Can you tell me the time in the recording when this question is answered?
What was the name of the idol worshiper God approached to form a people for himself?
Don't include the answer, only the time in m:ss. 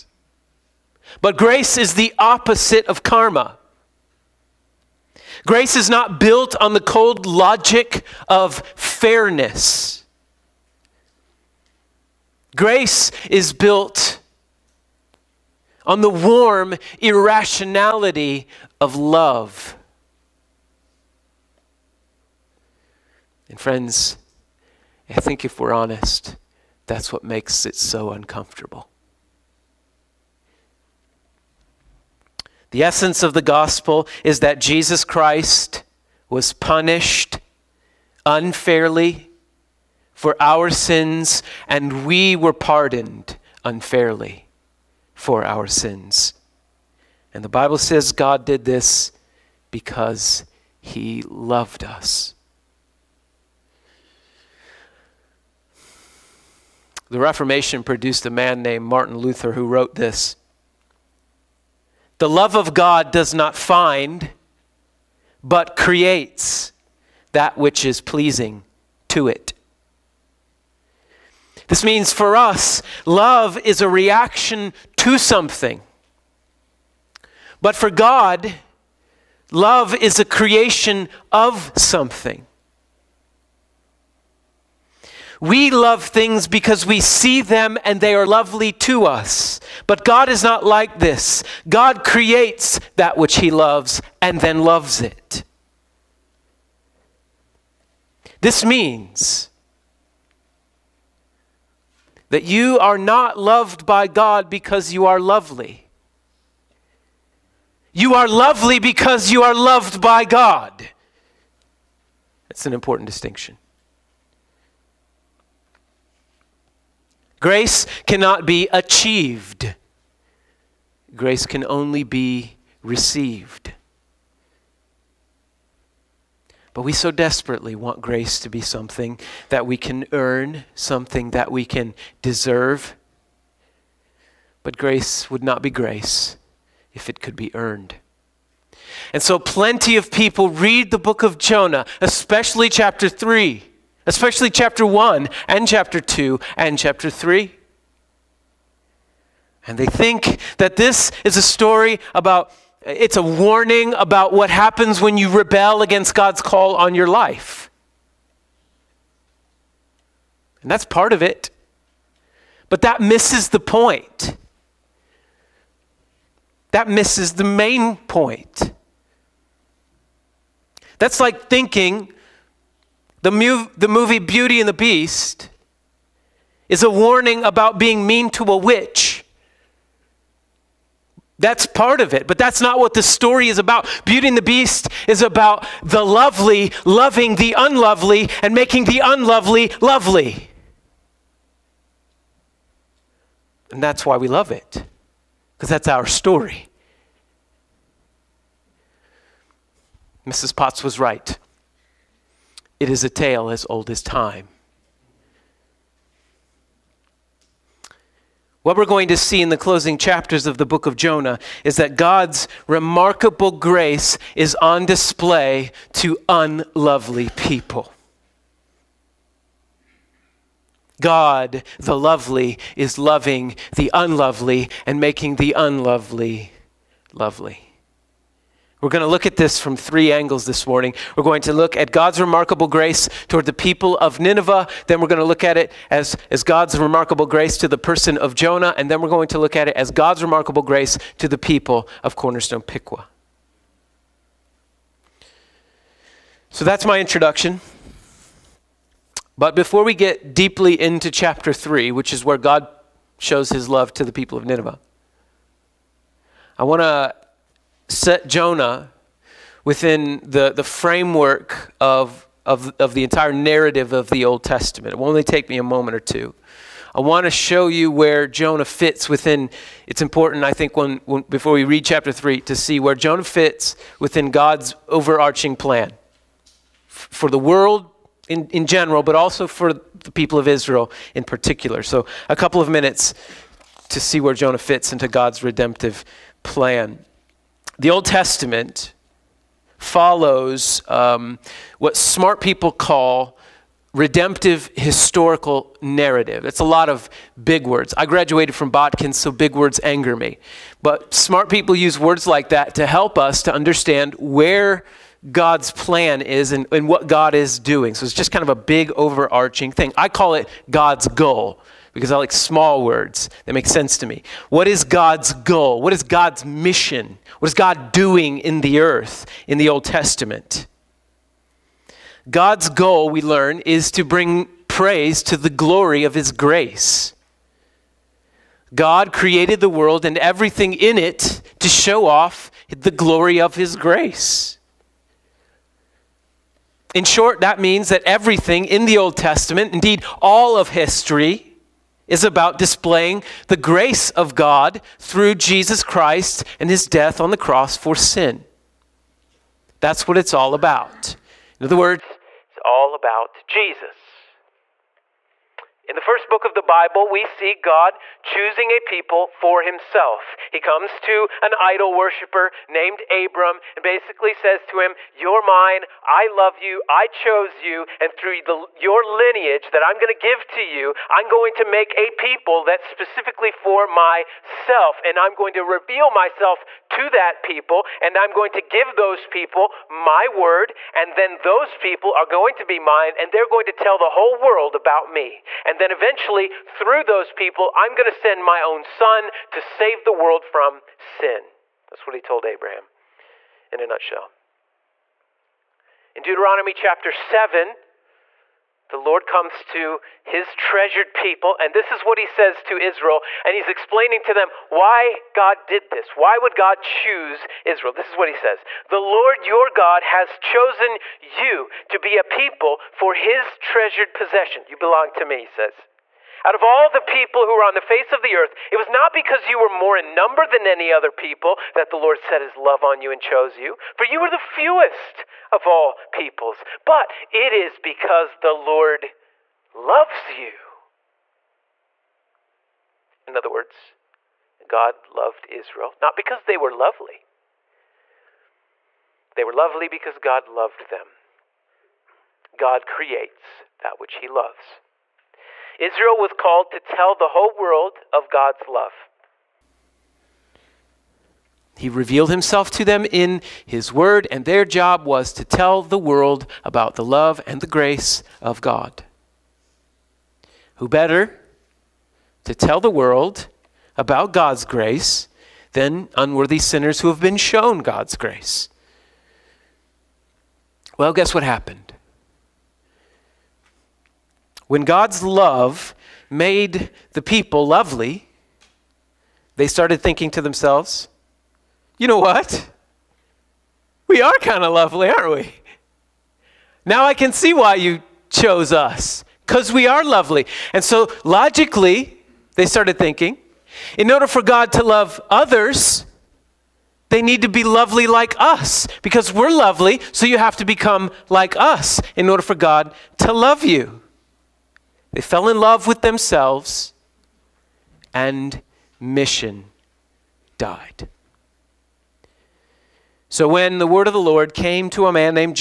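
6:03.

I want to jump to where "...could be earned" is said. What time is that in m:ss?
2:17.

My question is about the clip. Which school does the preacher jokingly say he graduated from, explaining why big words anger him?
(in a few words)
Botkin.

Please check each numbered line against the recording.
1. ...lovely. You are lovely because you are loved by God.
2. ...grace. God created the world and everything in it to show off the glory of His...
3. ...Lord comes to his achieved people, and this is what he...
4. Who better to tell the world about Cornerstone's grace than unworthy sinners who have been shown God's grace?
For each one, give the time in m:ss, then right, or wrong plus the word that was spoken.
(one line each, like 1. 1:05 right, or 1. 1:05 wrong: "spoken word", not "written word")
1. 1:45 right
2. 5:26 right
3. 6:38 wrong: "treasured", not "achieved"
4. 7:40 wrong: "God", not "Cornerstone".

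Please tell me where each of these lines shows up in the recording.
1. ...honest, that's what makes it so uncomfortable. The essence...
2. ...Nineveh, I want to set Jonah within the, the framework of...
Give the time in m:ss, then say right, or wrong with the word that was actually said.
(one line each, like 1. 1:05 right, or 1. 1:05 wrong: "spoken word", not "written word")
1. 0:25 right
2. 4:14 right.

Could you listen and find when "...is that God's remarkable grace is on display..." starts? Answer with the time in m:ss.
3:31.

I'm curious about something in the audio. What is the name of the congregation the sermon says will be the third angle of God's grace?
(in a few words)
Cornerstone Piqua.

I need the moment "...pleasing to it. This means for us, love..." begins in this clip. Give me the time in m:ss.
1:07.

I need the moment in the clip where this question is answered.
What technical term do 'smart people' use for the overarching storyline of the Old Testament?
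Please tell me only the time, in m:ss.
4:53.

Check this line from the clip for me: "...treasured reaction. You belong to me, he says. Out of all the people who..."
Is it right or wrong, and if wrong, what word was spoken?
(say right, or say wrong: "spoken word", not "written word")
wrong: "possession", not "reaction".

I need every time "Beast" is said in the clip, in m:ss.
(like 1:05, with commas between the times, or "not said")
2:54, 3:04.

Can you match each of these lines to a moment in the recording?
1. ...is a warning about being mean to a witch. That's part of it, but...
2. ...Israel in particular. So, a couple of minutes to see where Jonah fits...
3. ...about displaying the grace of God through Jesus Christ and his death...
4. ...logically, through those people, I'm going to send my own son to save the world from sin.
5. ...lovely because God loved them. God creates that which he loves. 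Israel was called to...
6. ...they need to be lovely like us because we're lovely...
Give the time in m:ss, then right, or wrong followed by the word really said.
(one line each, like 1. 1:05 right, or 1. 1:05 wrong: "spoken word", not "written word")
1. 2:56 right
2. 4:40 right
3. 5:42 right
4. 6:25 wrong: "eventually", not "logically"
5. 7:19 right
6. 8:17 right.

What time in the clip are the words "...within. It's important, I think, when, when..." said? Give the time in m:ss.
4:29.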